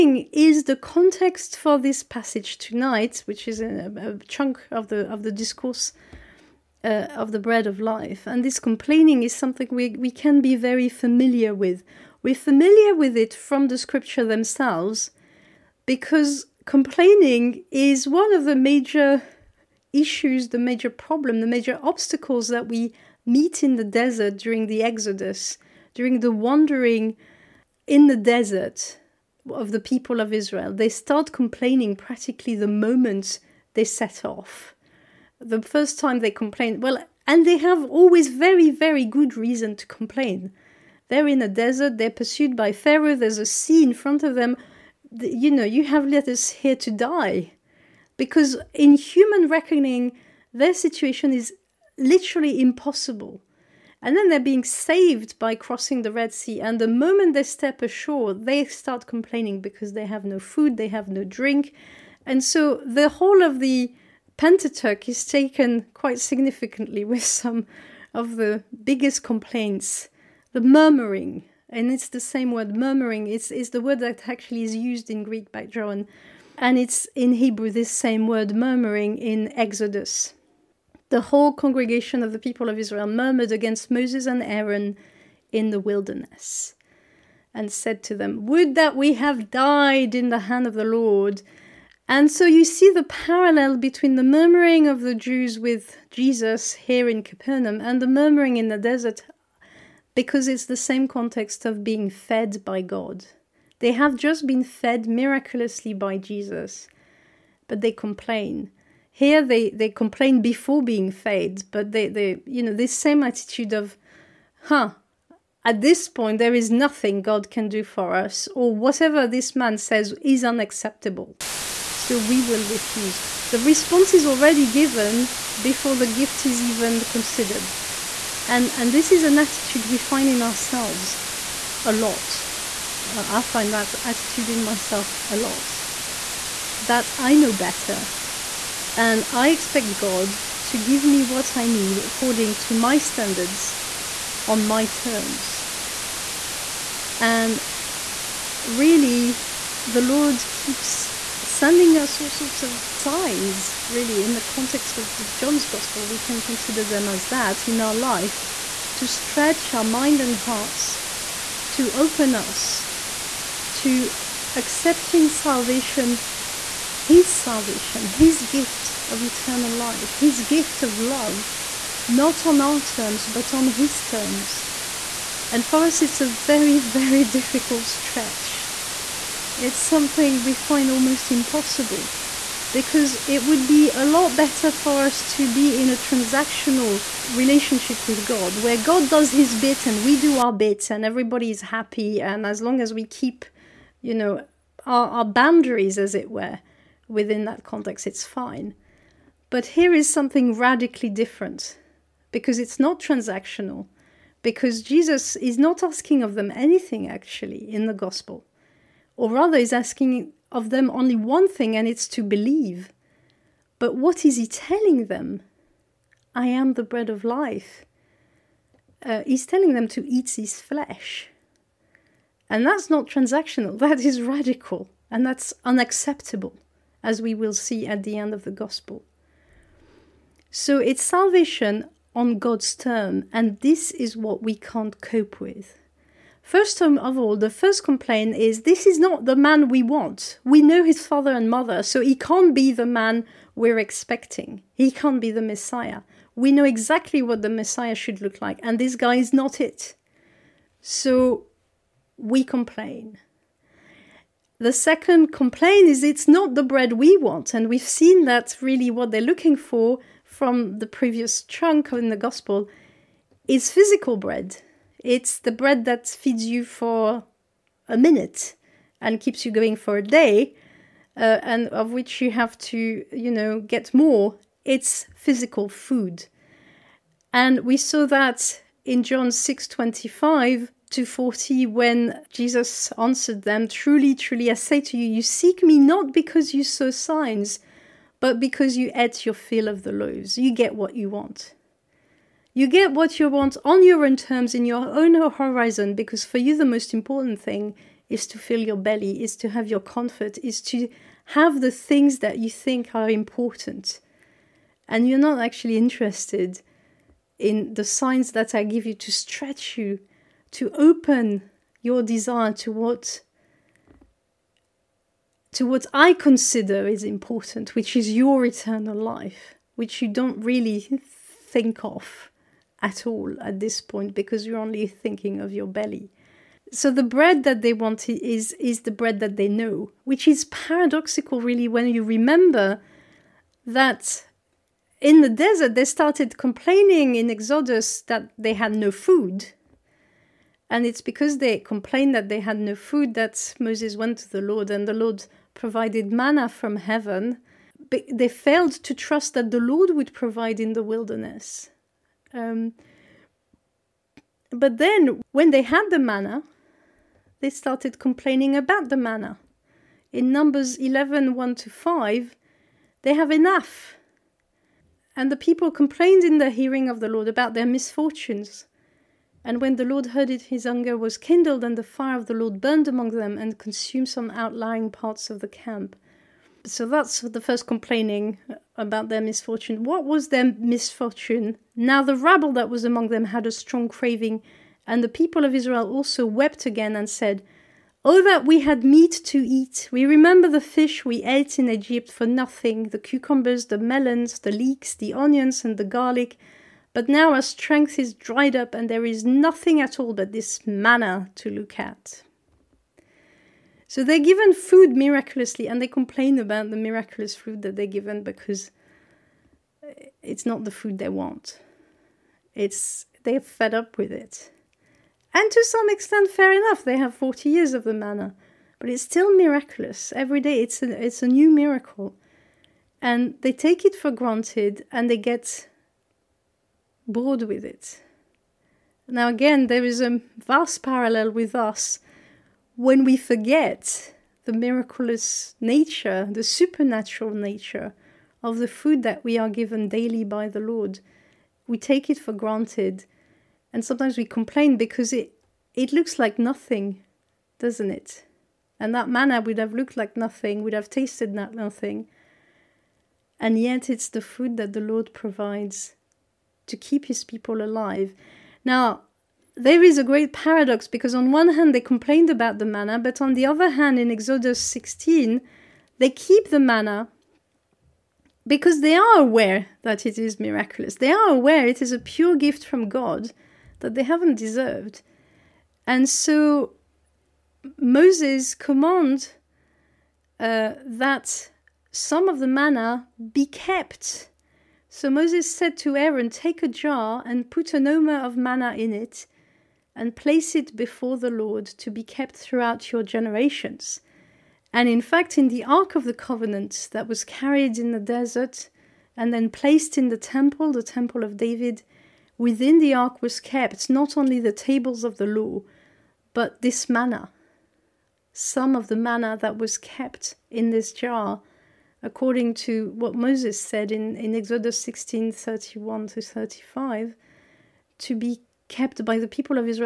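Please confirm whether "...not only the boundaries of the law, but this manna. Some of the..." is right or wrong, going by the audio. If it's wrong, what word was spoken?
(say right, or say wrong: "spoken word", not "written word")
wrong: "tables", not "boundaries".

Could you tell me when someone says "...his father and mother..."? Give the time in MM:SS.
04:00.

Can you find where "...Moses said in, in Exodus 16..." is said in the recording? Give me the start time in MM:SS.
08:33.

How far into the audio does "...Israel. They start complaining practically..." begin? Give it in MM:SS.
00:30.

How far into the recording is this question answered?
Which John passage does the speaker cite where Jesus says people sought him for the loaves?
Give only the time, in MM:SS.
04:39.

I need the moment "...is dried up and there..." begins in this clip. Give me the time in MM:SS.
06:37.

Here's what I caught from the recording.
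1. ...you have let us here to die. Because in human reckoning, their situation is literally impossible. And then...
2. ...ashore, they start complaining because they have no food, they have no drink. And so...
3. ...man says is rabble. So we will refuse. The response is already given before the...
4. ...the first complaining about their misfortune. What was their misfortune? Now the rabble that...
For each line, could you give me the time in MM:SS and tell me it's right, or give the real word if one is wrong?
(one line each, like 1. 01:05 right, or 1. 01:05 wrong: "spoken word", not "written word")
1. 00:45 right
2. 00:57 right
3. 01:59 wrong: "unacceptable", not "rabble"
4. 06:17 right.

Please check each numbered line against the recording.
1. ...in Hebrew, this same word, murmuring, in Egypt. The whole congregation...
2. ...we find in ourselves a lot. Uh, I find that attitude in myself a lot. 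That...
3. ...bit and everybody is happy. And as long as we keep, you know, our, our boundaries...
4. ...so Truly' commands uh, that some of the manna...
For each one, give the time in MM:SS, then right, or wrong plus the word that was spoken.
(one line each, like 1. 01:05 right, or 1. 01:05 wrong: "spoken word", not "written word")
1. 01:17 wrong: "Exodus", not "Egypt"
2. 02:09 right
3. 03:10 right
4. 07:56 wrong: "Moses", not "Truly".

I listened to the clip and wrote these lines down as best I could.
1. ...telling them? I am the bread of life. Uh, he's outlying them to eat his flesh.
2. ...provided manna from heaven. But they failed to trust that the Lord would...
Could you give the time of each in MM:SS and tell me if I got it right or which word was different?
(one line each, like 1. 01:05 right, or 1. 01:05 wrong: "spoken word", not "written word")
1. 03:34 wrong: "telling", not "outlying"
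2. 05:45 right.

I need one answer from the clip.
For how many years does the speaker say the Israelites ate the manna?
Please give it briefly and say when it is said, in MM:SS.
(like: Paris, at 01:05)
40, at 06:57.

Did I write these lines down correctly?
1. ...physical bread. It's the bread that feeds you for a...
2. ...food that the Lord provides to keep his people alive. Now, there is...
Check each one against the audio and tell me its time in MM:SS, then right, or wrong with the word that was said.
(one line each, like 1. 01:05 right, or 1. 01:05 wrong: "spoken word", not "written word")
1. 04:23 right
2. 07:34 right.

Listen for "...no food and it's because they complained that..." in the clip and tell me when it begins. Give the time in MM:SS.
05:38.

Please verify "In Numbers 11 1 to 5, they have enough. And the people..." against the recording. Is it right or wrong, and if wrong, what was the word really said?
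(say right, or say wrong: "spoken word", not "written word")
right.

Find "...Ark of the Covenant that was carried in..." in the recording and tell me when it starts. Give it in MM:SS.
08:15.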